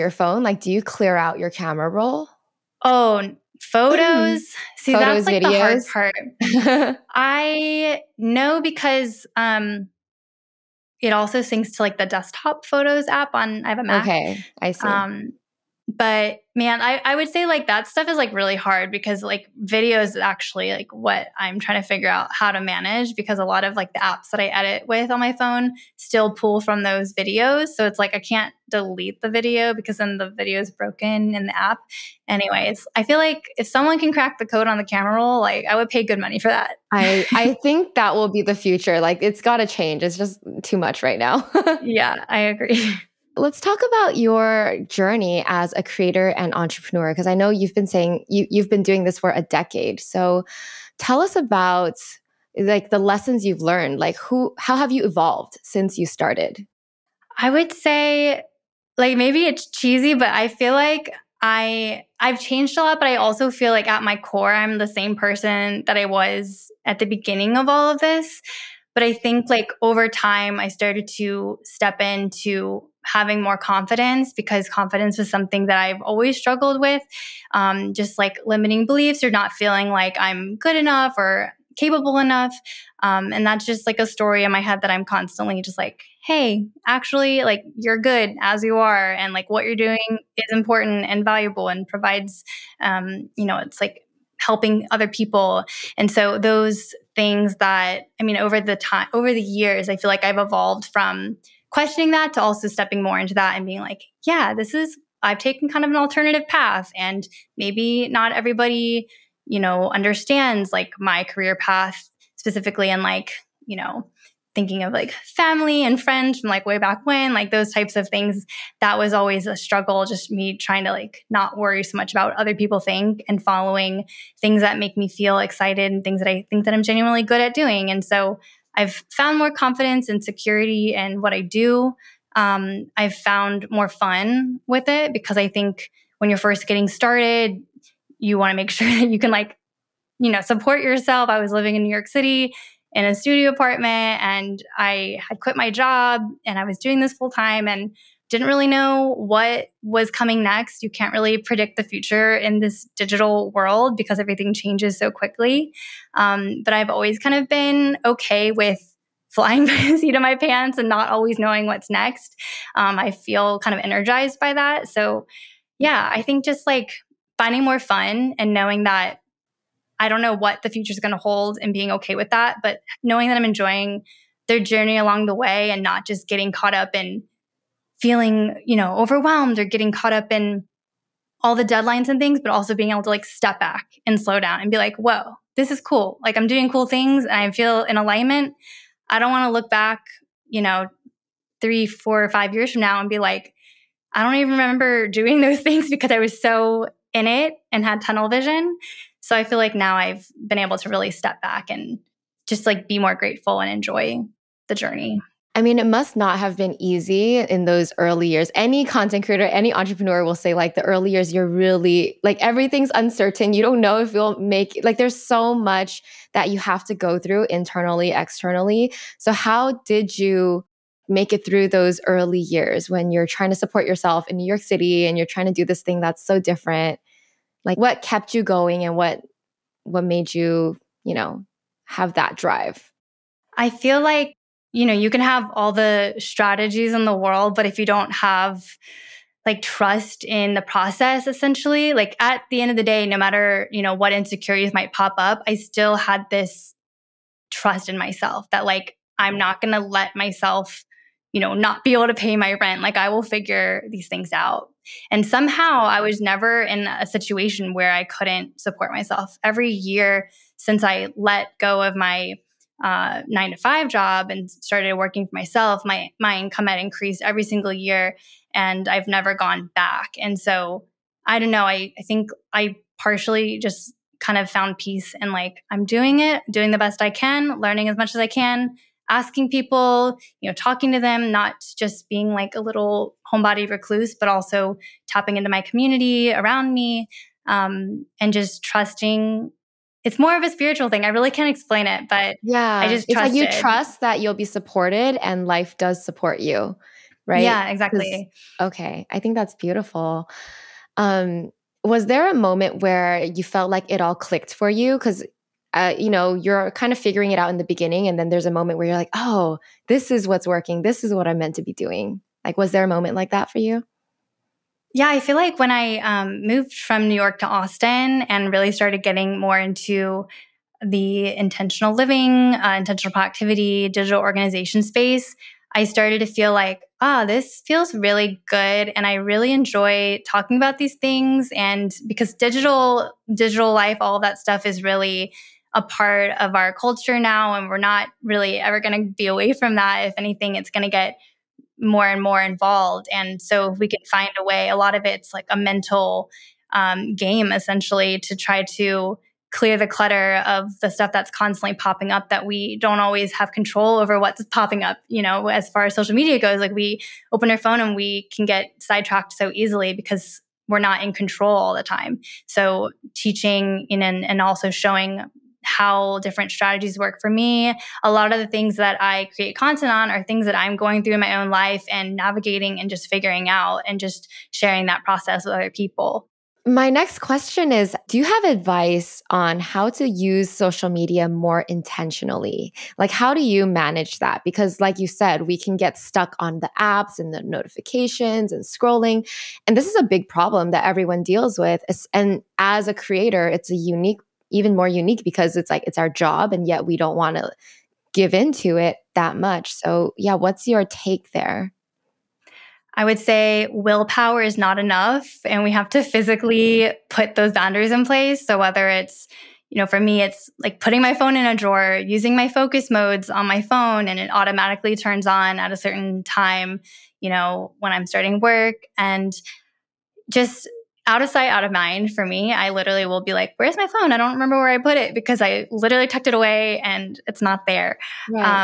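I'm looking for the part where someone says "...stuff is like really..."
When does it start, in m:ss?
0:17.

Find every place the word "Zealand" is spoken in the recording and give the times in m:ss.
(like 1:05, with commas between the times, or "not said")
not said.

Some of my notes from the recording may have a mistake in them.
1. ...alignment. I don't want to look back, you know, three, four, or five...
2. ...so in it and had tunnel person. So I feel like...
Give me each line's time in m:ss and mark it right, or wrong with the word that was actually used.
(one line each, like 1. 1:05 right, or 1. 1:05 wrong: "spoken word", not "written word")
1. 3:07 right
2. 3:16 wrong: "vision", not "person".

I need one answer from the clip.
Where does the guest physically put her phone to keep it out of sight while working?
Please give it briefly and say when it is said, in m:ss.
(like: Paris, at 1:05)
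in a drawer, at 6:51.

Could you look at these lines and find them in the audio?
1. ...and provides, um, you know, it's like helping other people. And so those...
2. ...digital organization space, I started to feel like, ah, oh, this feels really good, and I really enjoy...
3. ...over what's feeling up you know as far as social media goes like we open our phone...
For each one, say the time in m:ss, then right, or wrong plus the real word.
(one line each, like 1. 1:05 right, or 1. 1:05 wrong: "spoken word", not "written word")
1. 1:31 right
2. 5:23 right
3. 5:53 wrong: "popping", not "feeling".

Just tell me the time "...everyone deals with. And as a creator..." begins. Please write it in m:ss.
6:30.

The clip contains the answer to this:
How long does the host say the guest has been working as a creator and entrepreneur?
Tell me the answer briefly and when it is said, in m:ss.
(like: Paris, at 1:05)
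a decade, at 0:49.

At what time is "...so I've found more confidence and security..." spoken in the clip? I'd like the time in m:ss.
2:08.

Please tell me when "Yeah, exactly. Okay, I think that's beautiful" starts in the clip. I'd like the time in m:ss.
4:57.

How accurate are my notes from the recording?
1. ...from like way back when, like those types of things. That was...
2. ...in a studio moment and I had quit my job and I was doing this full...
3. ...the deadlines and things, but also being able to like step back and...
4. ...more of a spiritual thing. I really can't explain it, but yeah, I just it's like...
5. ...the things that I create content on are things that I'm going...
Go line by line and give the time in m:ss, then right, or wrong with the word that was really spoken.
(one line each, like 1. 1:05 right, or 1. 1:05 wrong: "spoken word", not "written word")
1. 1:56 right
2. 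2:22 wrong: "apartment", not "moment"
3. 3:01 right
4. 4:50 right
5. 6:08 right.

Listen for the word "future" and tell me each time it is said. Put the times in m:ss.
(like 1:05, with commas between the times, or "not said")
0:38, 2:31, 2:50.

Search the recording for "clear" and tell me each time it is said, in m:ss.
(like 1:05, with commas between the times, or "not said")
0:00, 5:49.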